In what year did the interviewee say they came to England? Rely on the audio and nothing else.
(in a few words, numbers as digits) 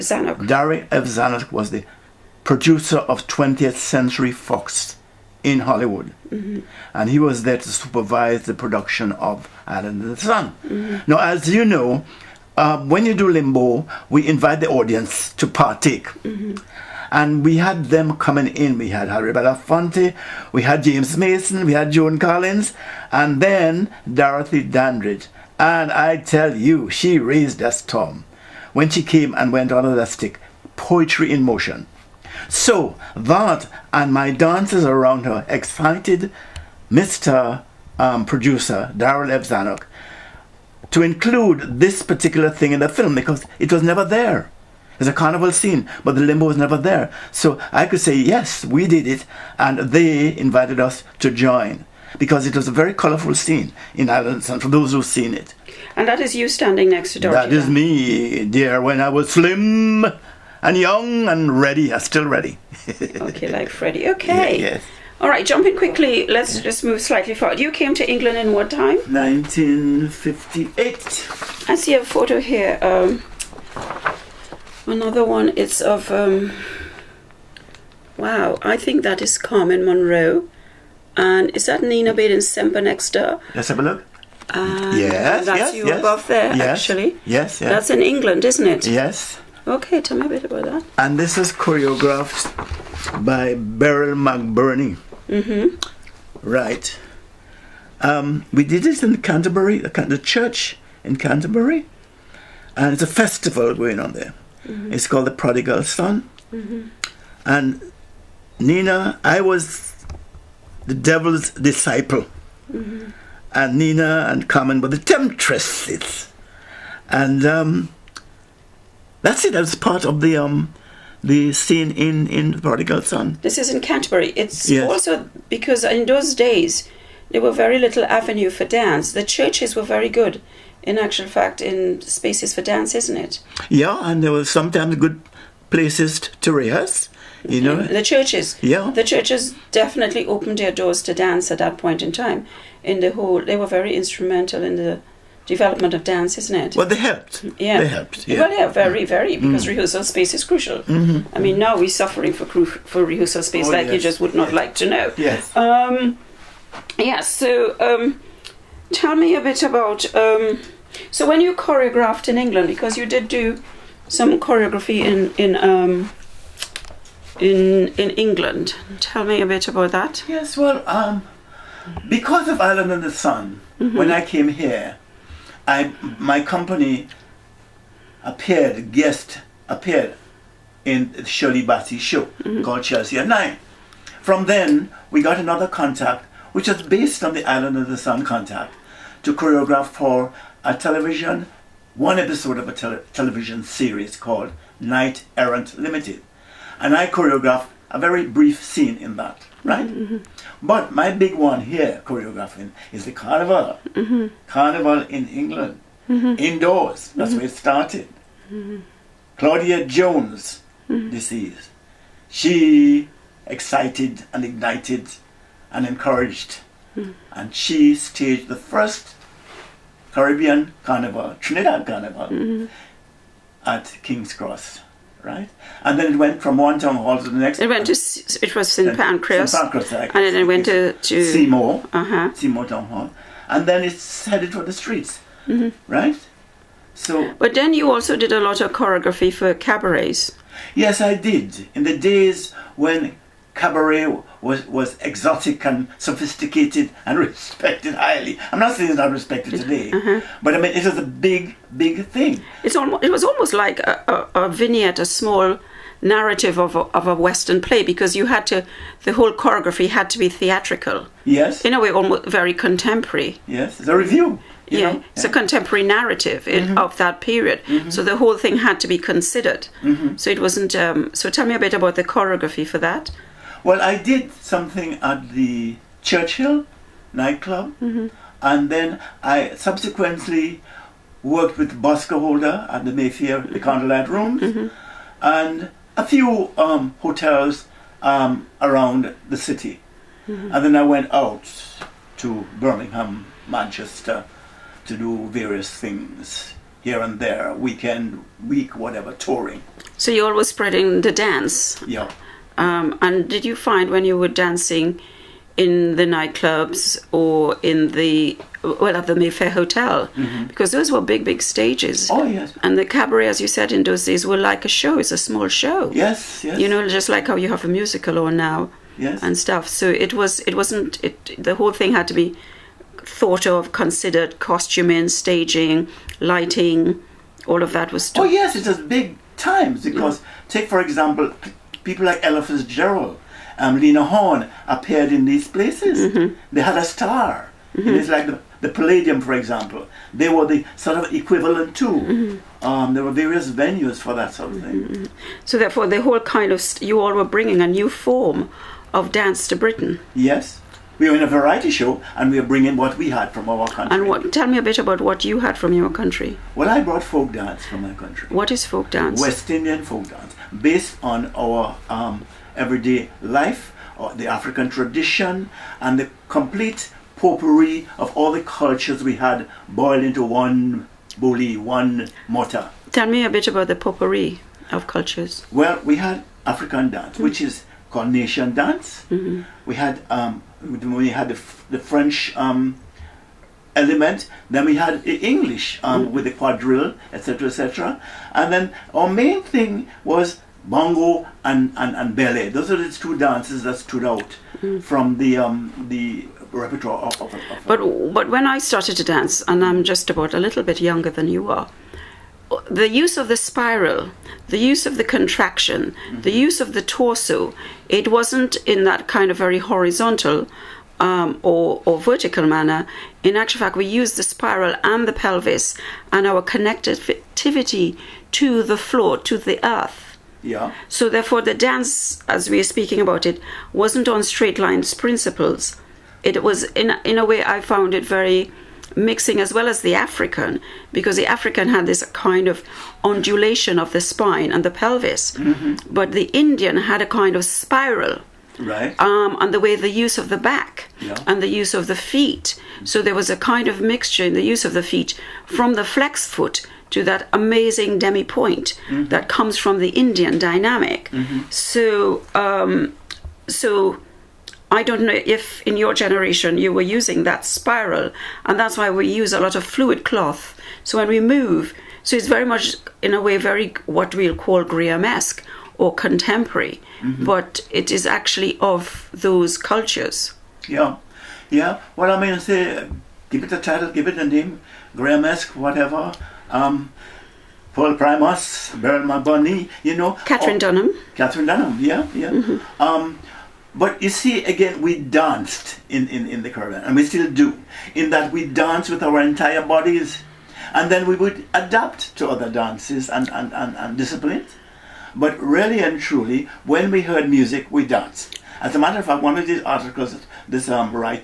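1958.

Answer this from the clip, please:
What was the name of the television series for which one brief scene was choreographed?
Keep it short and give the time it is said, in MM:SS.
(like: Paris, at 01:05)
Knight Errant Limited, at 03:14.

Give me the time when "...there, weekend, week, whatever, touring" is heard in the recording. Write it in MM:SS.
04:57.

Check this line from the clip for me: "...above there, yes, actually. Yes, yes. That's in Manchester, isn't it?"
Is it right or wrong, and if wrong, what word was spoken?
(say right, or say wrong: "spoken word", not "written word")
wrong: "England", not "Manchester".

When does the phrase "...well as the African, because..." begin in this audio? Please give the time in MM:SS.
07:09.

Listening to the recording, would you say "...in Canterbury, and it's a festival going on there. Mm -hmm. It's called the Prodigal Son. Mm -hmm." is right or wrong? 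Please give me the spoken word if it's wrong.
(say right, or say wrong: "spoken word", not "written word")
right.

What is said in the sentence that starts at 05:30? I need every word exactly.
take for example People like Ella Fitzgerald, um, Lena Horne appeared in these places.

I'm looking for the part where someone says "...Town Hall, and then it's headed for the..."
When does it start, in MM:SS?
03:52.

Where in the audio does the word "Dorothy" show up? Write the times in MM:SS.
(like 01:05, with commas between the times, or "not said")
00:24, 00:57.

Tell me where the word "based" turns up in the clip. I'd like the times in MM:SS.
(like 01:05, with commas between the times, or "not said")
03:06, 06:00.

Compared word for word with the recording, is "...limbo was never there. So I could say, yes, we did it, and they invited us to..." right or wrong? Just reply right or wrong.
right.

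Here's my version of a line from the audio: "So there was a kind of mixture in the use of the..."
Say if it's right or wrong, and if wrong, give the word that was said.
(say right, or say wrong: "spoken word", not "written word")
right.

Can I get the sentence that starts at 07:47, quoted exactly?
but it is actually of those cultures.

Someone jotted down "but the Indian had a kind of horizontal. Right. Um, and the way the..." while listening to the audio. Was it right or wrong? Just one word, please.
wrong.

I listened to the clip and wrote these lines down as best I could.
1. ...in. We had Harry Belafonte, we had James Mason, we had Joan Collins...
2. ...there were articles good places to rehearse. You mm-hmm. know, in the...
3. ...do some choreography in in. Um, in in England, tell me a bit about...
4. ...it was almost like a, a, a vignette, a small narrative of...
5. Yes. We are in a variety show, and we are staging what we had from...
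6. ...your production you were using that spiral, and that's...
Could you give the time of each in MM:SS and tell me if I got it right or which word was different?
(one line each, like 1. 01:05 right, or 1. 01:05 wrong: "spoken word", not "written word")
1. 00:18 right
2. 02:14 wrong: "sometimes", not "articles"
3. 02:43 right
4. 04:13 right
5. 05:50 wrong: "bringing", not "staging"
6. 07:35 wrong: "generation", not "production".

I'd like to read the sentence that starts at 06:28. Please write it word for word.
And then our main thing was bongo and, and, and ballet.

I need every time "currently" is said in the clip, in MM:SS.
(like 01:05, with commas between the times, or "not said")
not said.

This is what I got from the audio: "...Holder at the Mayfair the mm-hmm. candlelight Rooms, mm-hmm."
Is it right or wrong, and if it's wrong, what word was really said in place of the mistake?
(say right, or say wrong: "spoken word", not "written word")
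right.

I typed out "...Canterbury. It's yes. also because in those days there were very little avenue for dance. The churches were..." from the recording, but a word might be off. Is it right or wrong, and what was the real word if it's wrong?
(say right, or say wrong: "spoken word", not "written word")
right.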